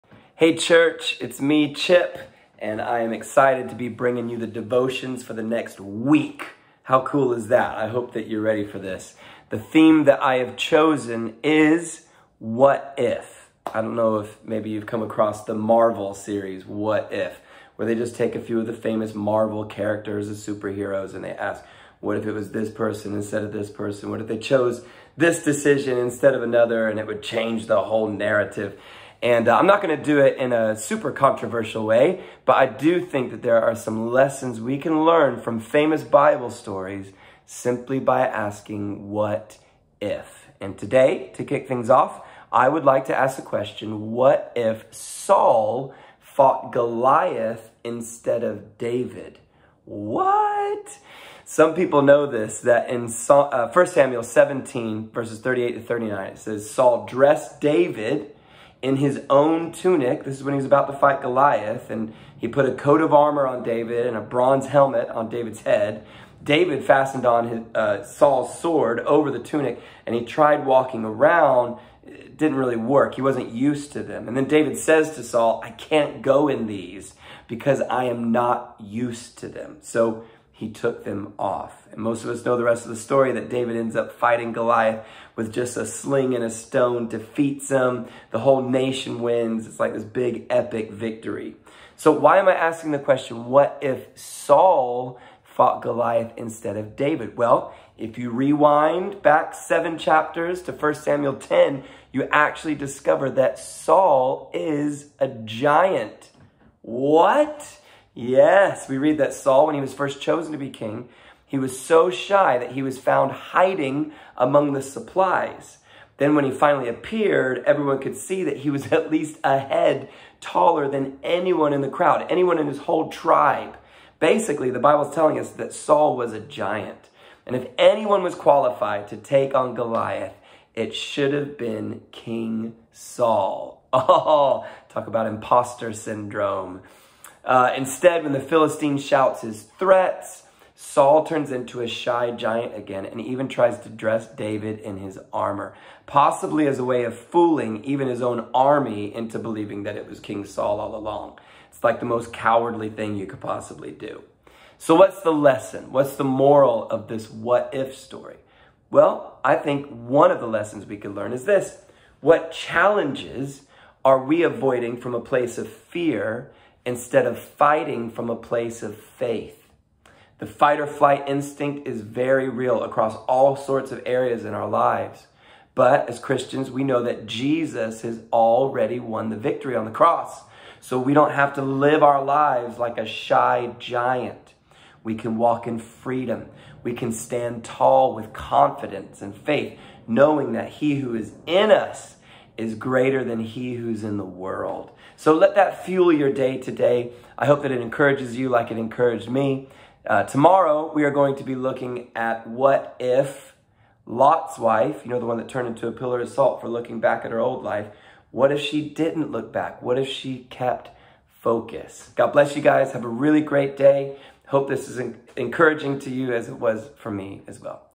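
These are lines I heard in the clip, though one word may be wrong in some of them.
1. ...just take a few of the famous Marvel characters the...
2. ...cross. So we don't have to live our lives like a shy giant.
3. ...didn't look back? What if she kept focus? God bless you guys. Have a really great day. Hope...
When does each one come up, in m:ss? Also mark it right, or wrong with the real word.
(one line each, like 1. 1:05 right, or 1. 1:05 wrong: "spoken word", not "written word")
1. 0:17 right
2. 2:59 right
3. 3:28 right.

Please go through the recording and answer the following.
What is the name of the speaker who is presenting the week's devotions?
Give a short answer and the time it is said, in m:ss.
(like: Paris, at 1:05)
Chip, at 0:01.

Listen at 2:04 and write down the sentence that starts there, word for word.
Basically, the Bible's telling us that Saul was a giant.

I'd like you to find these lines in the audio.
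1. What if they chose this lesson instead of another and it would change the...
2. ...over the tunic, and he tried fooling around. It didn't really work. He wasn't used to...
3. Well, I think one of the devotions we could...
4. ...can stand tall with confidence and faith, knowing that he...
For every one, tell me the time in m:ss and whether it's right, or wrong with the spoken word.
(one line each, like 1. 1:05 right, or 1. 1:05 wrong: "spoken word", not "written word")
1. 0:24 wrong: "decision", not "lesson"
2. 1:09 wrong: "walking", not "fooling"
3. 2:38 wrong: "lessons", not "devotions"
4. 3:06 right.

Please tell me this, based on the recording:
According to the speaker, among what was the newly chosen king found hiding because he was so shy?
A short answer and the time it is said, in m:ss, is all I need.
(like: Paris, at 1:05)
the supplies, at 1:54.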